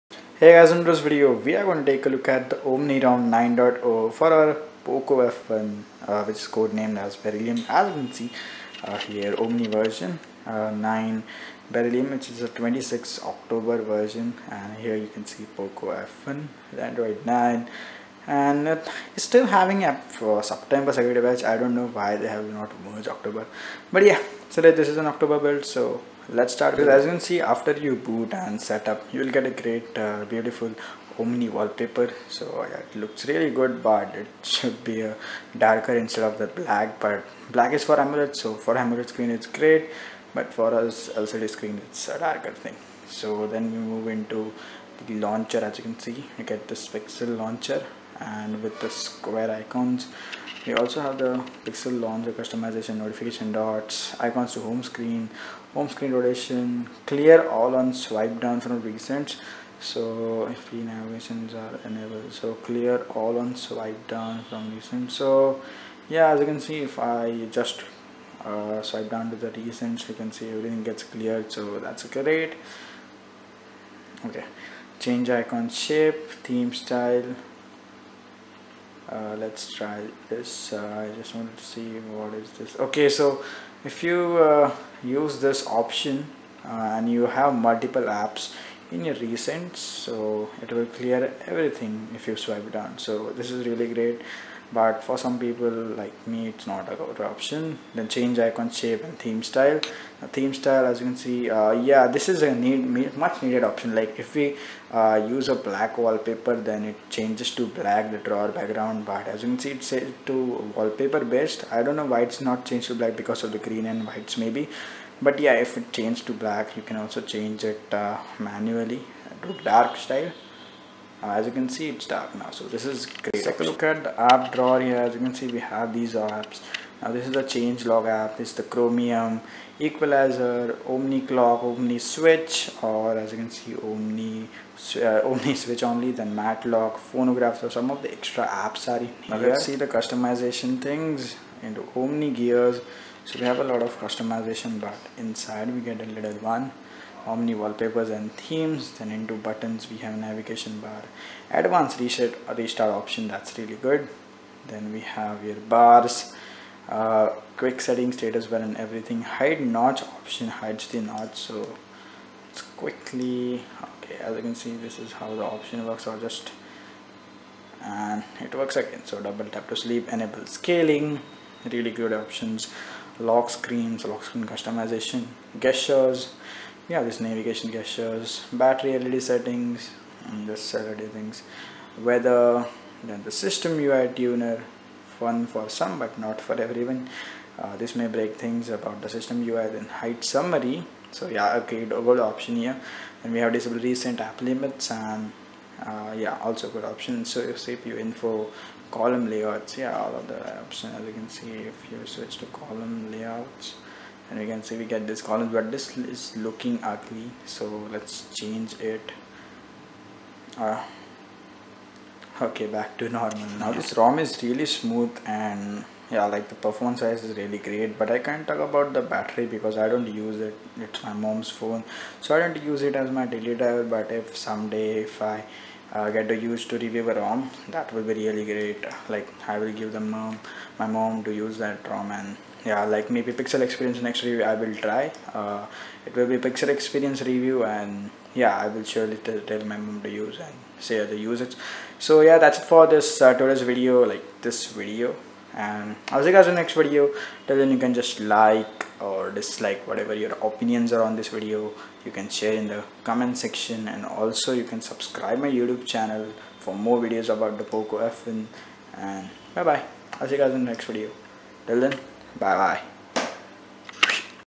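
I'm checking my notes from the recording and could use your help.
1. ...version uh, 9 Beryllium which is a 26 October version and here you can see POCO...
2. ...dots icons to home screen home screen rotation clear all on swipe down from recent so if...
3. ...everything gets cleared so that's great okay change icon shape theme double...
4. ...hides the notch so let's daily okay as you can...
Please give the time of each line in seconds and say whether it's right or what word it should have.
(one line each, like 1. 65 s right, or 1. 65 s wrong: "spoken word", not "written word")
1. 9 s right
2. 53 s right
3. 70 s wrong: "style", not "double"
4. 160 s wrong: "quickly", not "daily".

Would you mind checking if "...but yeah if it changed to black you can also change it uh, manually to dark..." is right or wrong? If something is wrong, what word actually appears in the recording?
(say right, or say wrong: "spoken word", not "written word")
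right.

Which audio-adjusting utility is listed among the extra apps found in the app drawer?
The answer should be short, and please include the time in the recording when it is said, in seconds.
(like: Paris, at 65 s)
equalizer, at 129 s.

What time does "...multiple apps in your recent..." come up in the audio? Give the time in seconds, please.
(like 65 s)
87 s.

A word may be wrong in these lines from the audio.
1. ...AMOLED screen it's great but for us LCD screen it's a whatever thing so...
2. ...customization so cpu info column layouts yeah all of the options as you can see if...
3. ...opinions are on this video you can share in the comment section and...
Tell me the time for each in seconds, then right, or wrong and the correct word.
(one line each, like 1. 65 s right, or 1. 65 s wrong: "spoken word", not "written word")
1. 38 s wrong: "darker", not "whatever"
2. 196 s wrong: "option", not "customization"
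3. 250 s right.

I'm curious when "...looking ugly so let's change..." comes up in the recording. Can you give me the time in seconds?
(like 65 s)
206 s.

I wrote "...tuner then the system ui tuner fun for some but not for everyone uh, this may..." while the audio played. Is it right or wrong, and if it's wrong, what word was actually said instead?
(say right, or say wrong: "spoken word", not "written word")
wrong: "weather", not "tuner".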